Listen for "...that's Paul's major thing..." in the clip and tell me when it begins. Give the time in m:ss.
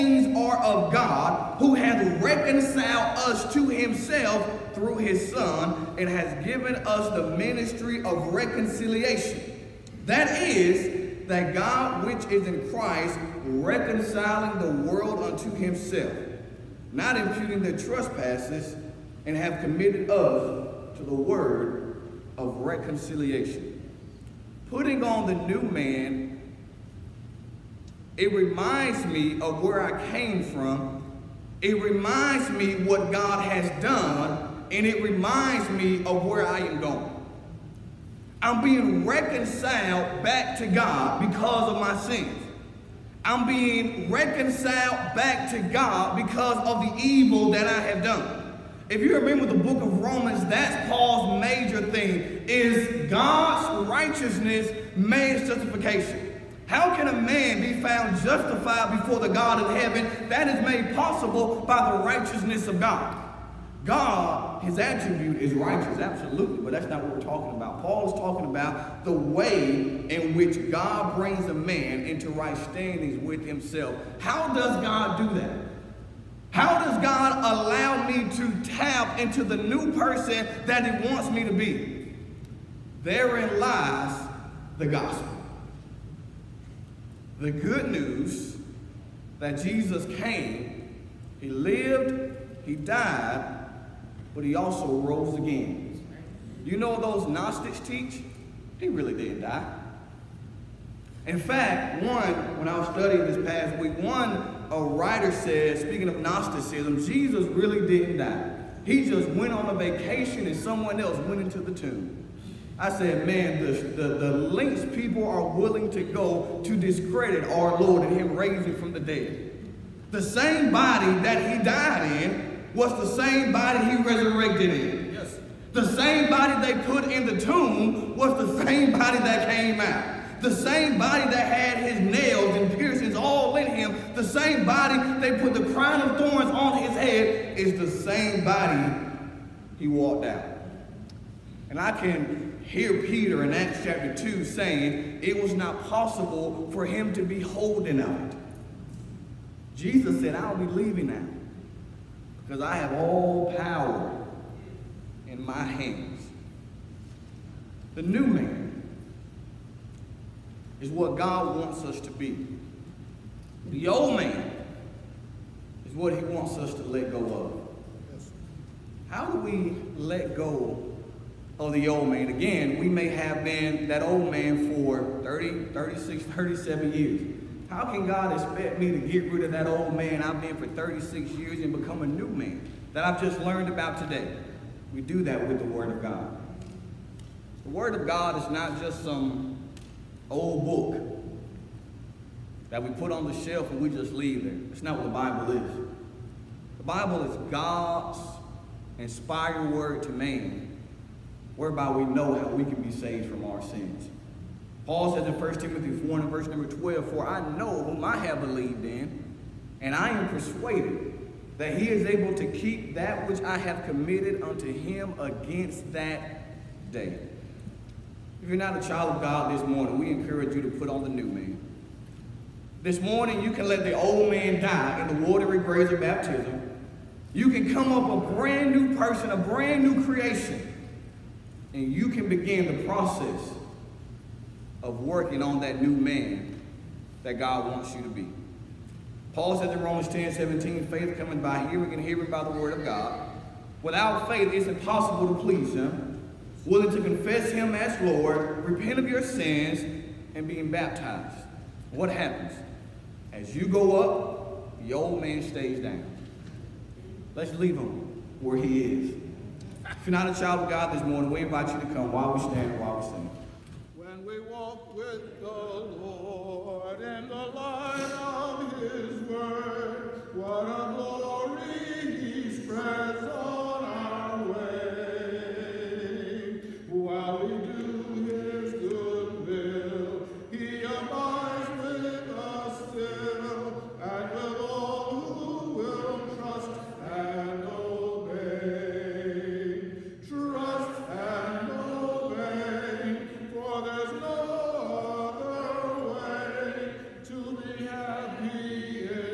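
0:50.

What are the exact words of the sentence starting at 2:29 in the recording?
Jesus said, I'll be leaving now because I have all power in my hands.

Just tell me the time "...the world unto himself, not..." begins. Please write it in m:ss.
0:14.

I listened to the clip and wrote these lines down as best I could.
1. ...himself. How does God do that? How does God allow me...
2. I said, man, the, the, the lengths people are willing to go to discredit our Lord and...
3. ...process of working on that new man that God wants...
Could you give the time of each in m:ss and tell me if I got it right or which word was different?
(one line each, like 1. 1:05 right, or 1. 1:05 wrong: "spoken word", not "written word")
1. 1:13 right
2. 1:52 right
3. 3:52 right.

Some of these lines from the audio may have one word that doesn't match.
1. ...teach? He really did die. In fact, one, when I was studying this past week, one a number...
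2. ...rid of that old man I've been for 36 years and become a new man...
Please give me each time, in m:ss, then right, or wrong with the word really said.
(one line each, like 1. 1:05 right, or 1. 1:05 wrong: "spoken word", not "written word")
1. 1:37 wrong: "writer", not "number"
2. 2:59 right.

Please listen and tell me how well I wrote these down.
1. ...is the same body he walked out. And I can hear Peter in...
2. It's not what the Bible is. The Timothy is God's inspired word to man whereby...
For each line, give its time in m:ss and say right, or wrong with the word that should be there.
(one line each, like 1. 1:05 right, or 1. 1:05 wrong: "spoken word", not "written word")
1. 2:17 right
2. 3:14 wrong: "Bible", not "Timothy".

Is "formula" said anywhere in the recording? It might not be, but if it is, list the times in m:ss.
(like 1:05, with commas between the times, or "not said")
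not said.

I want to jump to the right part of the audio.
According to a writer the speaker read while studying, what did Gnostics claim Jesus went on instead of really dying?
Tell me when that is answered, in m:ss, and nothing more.
1:49.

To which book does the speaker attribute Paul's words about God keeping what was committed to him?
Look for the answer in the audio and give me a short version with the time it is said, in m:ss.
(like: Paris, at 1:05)
1 Timothy, at 3:25.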